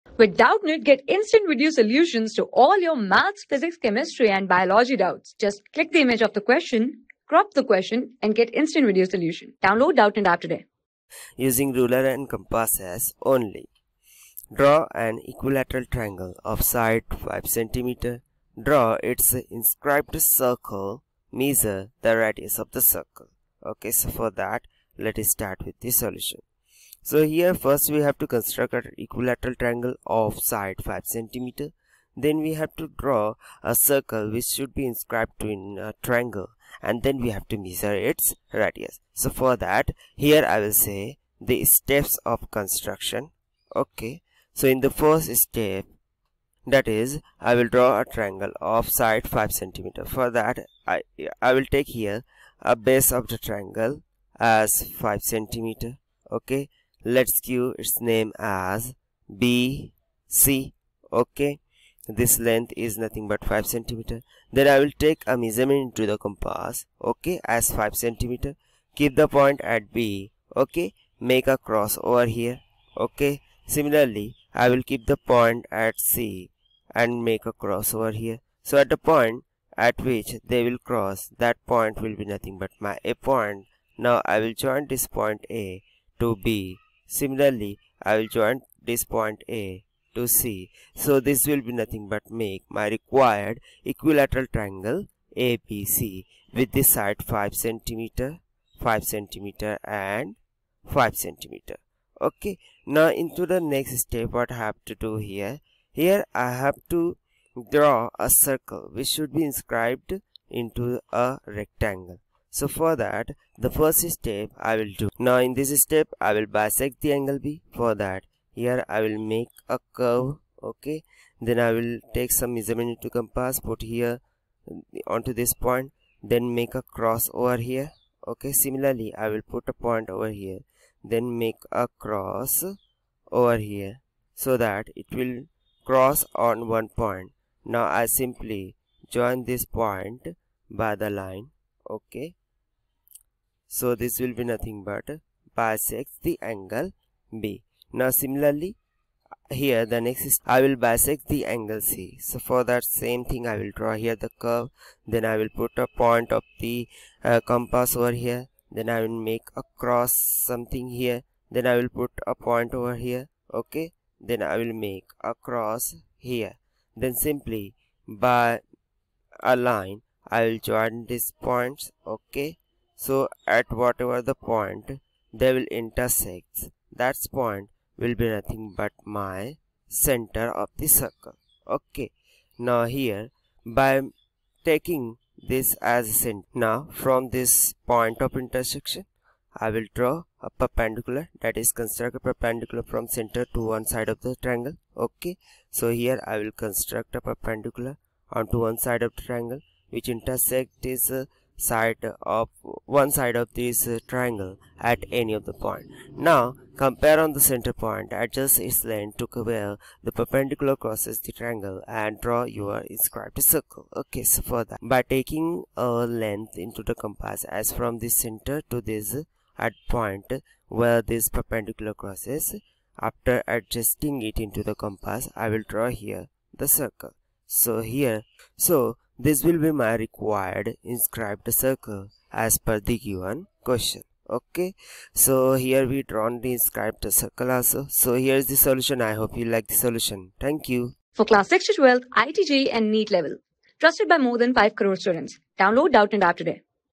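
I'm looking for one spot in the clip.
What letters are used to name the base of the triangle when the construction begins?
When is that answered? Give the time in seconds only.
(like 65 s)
59 s.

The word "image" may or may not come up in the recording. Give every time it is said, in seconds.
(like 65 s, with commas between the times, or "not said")
6 s.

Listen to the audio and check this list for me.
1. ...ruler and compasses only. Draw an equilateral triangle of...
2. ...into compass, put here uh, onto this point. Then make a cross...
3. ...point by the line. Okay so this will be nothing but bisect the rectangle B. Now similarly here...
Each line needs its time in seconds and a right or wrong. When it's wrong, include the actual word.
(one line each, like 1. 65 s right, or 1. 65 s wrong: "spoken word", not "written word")
1. 11 s right
2. 122 s right
3. 139 s wrong: "angle", not "rectangle".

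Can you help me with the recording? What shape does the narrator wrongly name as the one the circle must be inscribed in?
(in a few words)
rectangle.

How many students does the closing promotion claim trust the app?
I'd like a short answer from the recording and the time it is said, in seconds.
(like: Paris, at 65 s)
more than 5 crore, at 244 s.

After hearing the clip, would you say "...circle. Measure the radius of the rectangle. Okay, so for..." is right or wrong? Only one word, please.
wrong.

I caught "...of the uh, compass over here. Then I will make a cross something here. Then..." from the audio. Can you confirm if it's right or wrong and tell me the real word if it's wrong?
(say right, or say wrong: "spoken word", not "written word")
right.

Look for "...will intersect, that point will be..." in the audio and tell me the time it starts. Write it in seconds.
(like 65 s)
175 s.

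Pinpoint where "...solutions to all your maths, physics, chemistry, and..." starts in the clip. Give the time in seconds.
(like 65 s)
1 s.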